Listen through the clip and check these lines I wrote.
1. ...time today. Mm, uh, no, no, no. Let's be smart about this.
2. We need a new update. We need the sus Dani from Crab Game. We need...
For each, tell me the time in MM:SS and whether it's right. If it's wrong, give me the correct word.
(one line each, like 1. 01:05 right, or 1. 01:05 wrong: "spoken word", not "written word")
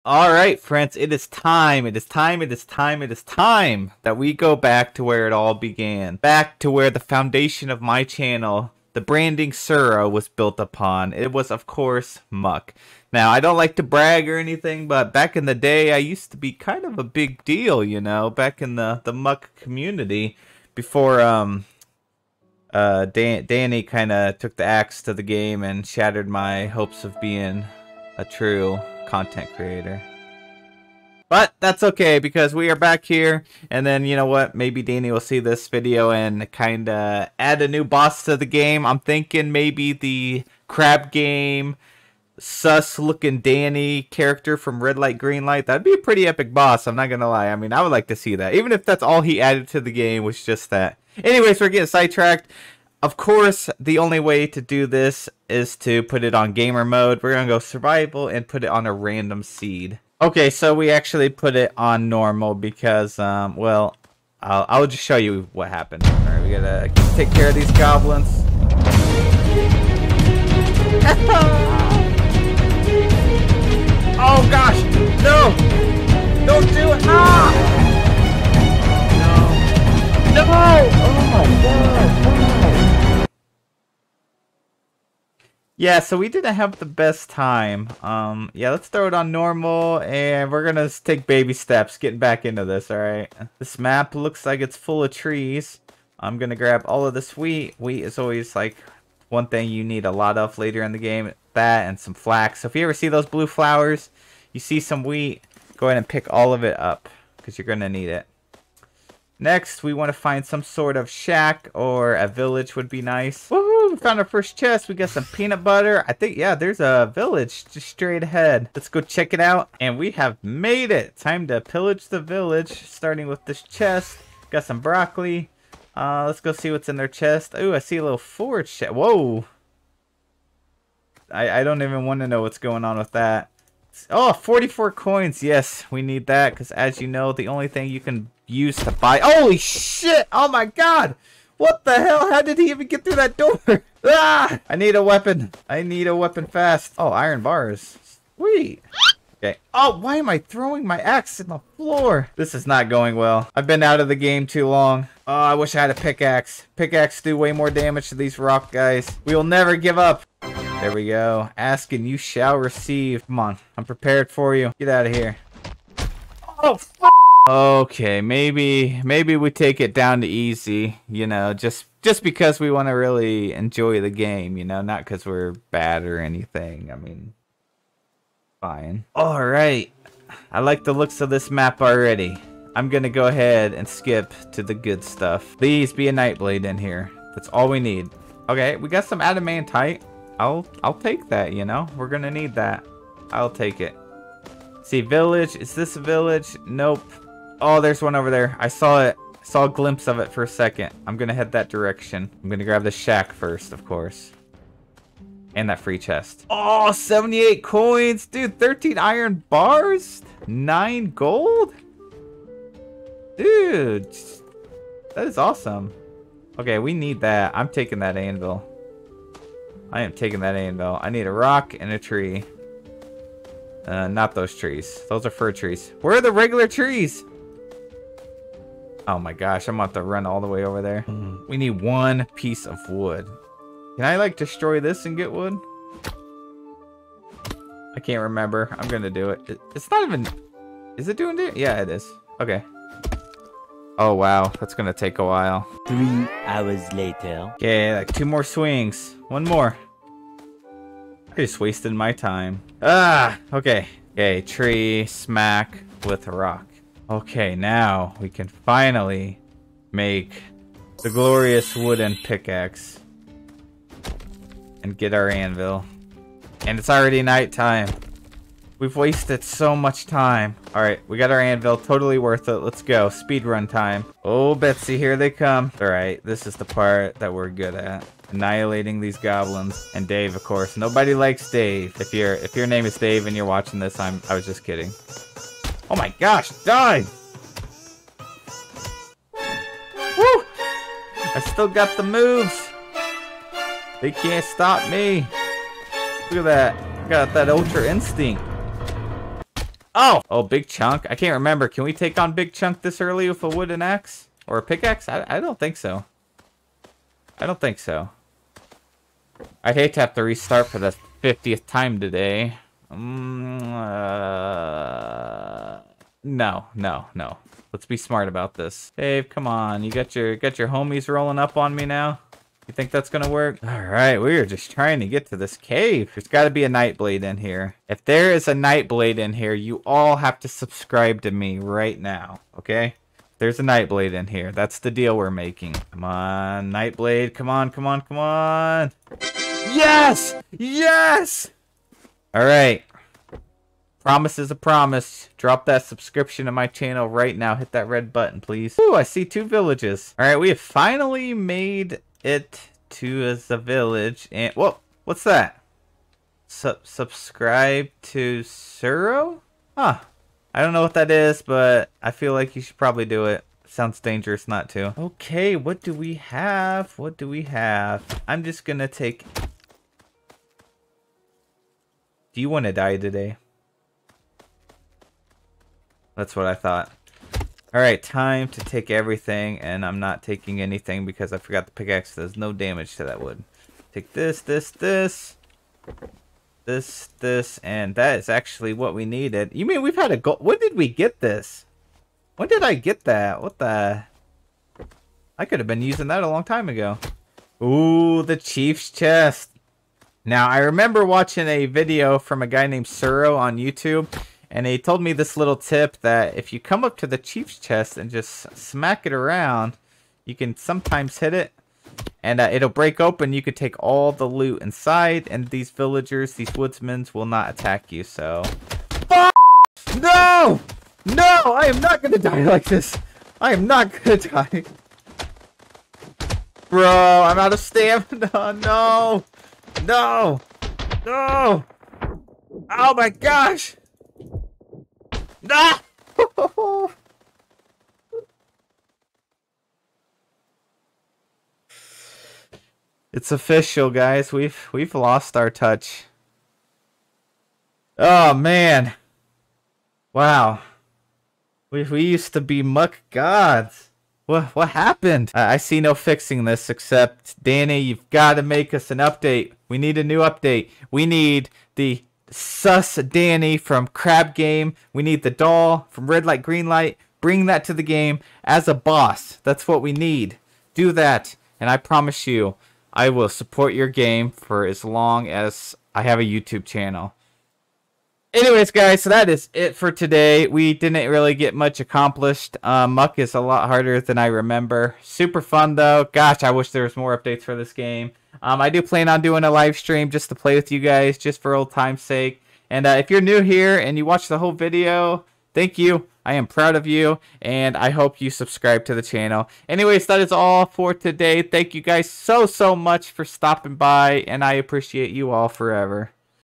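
1. 05:11 right
2. 07:39 right.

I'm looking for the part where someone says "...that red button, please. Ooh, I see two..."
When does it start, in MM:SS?
05:47.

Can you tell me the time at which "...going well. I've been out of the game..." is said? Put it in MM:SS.
02:32.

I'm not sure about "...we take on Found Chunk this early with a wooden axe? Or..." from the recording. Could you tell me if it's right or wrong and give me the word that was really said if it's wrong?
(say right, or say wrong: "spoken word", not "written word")
wrong: "Big", not "Found".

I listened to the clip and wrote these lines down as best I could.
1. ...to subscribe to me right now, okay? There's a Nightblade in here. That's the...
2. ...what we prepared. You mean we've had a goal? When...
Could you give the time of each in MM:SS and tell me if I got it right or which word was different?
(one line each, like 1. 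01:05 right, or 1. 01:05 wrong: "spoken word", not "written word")
1. 05:30 right
2. 06:28 wrong: "needed", not "prepared".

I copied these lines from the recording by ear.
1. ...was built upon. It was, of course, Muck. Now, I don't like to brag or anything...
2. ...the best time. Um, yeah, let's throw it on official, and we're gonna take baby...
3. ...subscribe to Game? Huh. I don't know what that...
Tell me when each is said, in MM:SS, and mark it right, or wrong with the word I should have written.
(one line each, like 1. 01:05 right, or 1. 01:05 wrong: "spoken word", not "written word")
1. 00:10 right
2. 01:26 wrong: "normal", not "official"
3. 05:56 wrong: "Serroh", not "Game".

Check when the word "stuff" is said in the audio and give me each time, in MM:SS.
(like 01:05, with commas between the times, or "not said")
03:05.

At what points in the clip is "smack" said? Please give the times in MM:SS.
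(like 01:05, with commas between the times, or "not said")
04:15, 06:48.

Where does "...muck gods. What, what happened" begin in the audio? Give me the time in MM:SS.
07:32.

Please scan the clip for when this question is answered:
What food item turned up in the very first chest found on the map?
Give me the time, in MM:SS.
01:55.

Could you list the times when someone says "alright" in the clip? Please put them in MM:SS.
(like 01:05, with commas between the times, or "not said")
01:32, 04:30, 04:35, 05:42, 05:50, 06:17.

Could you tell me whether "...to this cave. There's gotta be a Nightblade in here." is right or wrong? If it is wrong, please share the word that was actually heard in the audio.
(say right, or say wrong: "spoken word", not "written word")
right.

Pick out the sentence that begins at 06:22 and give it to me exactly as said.
There's no damage to that wood.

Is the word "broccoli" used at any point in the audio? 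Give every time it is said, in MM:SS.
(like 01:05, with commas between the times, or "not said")
02:04.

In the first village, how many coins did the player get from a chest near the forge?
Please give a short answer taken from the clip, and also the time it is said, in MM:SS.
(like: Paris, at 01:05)
44, at 02:14.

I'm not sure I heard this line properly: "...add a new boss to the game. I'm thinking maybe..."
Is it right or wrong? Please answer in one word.
right.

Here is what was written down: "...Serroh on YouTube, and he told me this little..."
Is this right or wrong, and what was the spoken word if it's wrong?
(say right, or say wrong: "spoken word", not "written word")
right.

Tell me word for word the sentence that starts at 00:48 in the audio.
Even if that's all he added to the game was just that.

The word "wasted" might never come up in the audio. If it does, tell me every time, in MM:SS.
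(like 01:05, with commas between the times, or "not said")
04:11, 04:28.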